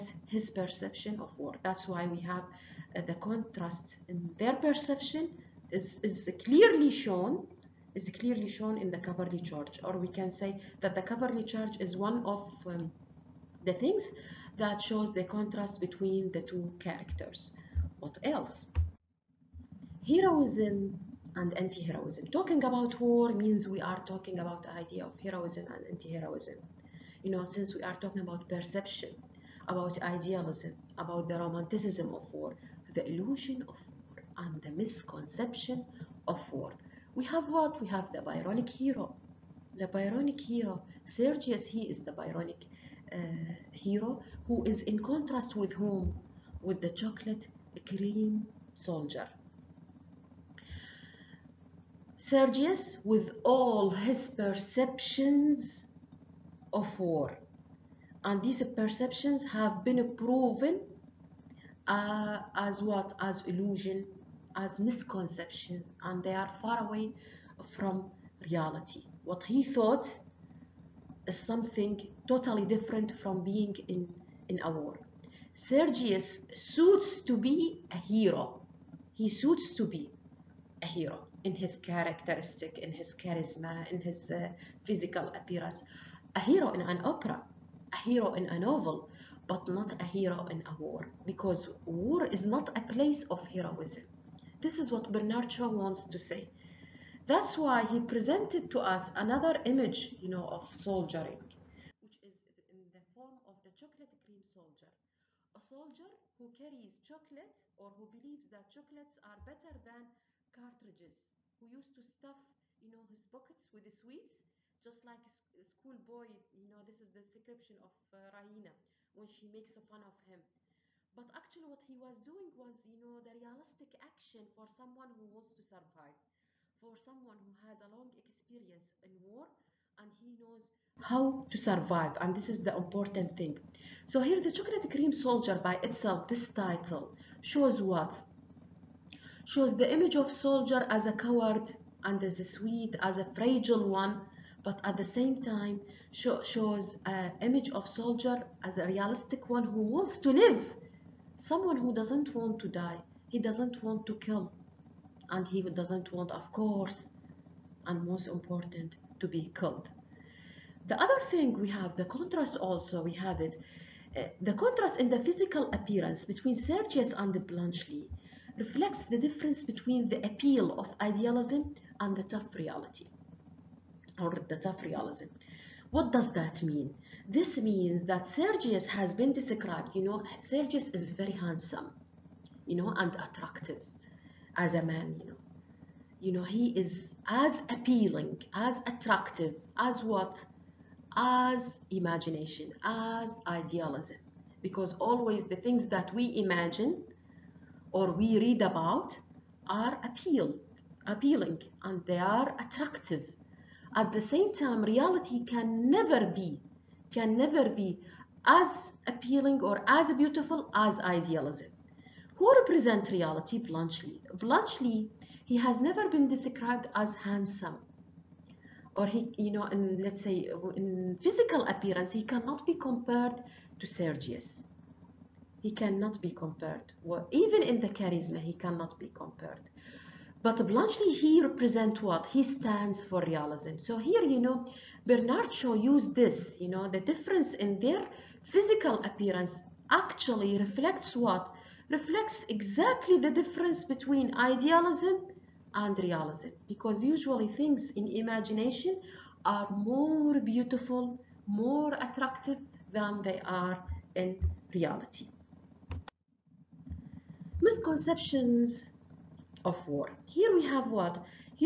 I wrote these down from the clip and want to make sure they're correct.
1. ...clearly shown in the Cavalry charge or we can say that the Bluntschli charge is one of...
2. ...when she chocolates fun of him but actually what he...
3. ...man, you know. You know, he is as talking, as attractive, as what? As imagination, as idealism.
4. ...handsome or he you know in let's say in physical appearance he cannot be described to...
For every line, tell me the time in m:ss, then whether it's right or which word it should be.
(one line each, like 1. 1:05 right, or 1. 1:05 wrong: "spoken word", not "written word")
1. 0:08 wrong: "Cavalry", not "Bluntschli"
2. 1:59 wrong: "makes", not "chocolates"
3. 3:04 wrong: "appealing", not "talking"
4. 3:37 wrong: "compared", not "described".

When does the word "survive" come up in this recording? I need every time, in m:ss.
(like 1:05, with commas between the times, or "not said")
2:05, 2:11.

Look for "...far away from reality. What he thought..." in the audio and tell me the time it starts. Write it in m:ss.
1:06.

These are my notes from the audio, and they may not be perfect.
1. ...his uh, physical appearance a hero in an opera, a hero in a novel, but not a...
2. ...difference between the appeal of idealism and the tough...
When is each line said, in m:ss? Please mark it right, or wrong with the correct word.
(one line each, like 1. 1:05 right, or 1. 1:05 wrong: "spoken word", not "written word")
1. 1:24 right
2. 2:49 right.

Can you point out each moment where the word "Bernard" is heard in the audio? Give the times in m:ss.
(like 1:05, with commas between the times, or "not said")
1:35, 3:55.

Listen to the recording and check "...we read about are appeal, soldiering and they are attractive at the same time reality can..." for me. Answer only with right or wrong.
wrong.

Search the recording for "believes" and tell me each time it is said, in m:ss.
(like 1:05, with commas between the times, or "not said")
1:48.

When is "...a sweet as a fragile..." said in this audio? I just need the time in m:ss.
2:22.